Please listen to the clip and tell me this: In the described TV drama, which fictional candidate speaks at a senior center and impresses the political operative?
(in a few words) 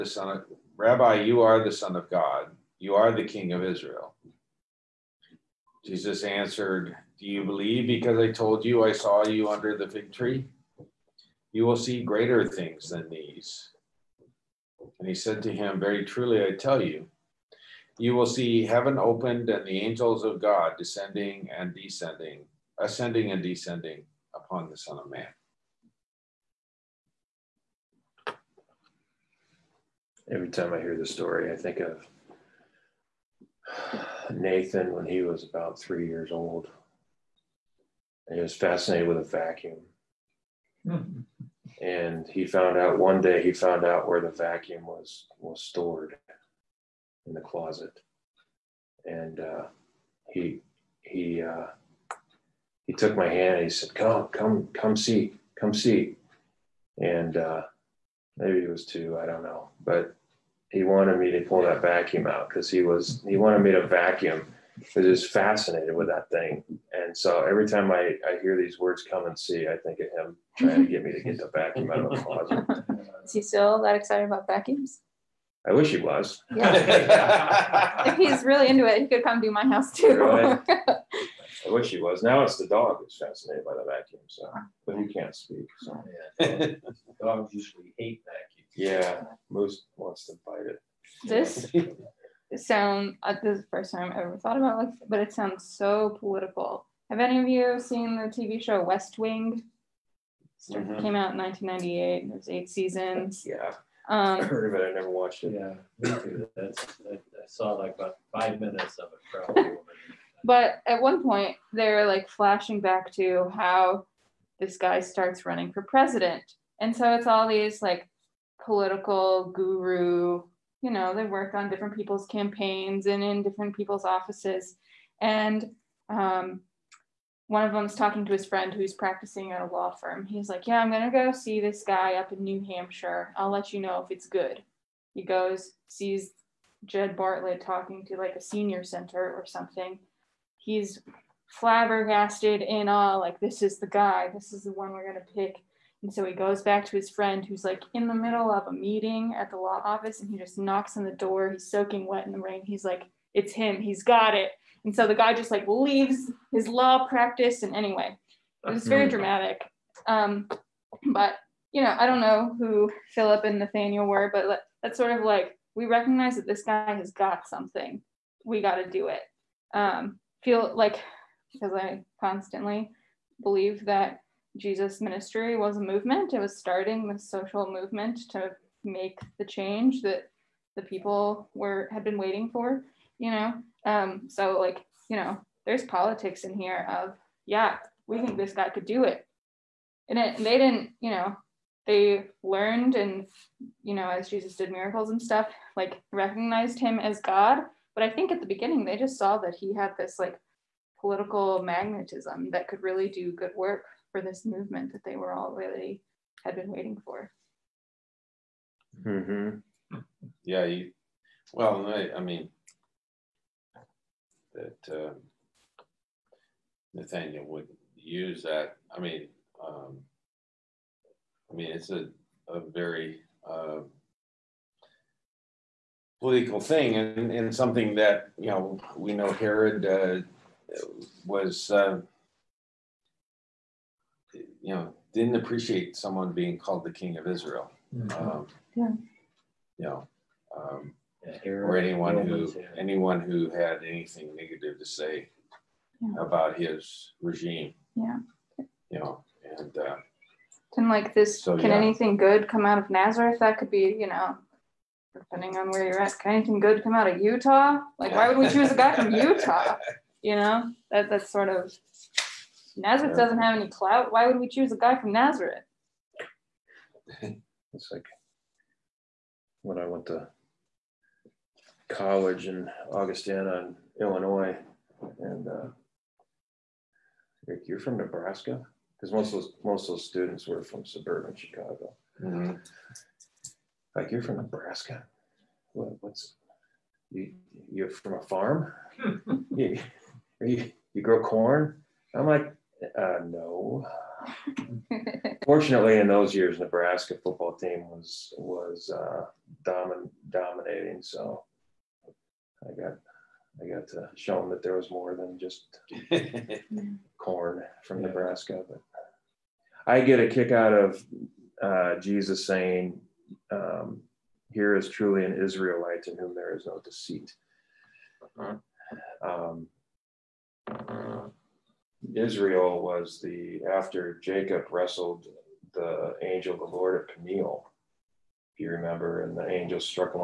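Jed Bartlet.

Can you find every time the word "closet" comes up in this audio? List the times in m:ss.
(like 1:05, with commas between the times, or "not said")
0:47, 1:12.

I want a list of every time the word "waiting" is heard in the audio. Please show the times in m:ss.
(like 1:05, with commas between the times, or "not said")
3:02, 3:26.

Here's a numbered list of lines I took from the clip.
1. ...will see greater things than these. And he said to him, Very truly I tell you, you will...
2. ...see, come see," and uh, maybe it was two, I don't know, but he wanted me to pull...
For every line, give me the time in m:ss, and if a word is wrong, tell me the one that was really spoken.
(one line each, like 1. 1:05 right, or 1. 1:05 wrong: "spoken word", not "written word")
1. 0:11 right
2. 0:54 right.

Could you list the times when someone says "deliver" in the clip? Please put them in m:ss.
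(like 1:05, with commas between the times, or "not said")
not said.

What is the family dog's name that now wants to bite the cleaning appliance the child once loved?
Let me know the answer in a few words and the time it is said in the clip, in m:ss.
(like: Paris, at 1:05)
Moose, at 1:29.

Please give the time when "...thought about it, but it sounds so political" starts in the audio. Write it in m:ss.
1:34.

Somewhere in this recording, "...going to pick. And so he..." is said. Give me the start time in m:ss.
2:25.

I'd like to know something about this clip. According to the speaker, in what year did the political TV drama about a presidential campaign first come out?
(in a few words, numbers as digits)
1998.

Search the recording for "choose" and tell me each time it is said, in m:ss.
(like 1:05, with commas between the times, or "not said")
4:18, 4:24.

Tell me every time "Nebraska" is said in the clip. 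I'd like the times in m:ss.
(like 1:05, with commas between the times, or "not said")
4:37, 4:44, 4:56, 5:08.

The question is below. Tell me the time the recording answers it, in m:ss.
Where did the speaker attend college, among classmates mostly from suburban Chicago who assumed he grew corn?
4:32.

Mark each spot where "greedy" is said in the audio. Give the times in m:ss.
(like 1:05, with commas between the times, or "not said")
not said.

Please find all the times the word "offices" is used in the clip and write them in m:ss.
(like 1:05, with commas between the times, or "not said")
2:04, 2:29.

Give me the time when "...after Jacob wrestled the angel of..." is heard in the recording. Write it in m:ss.
5:23.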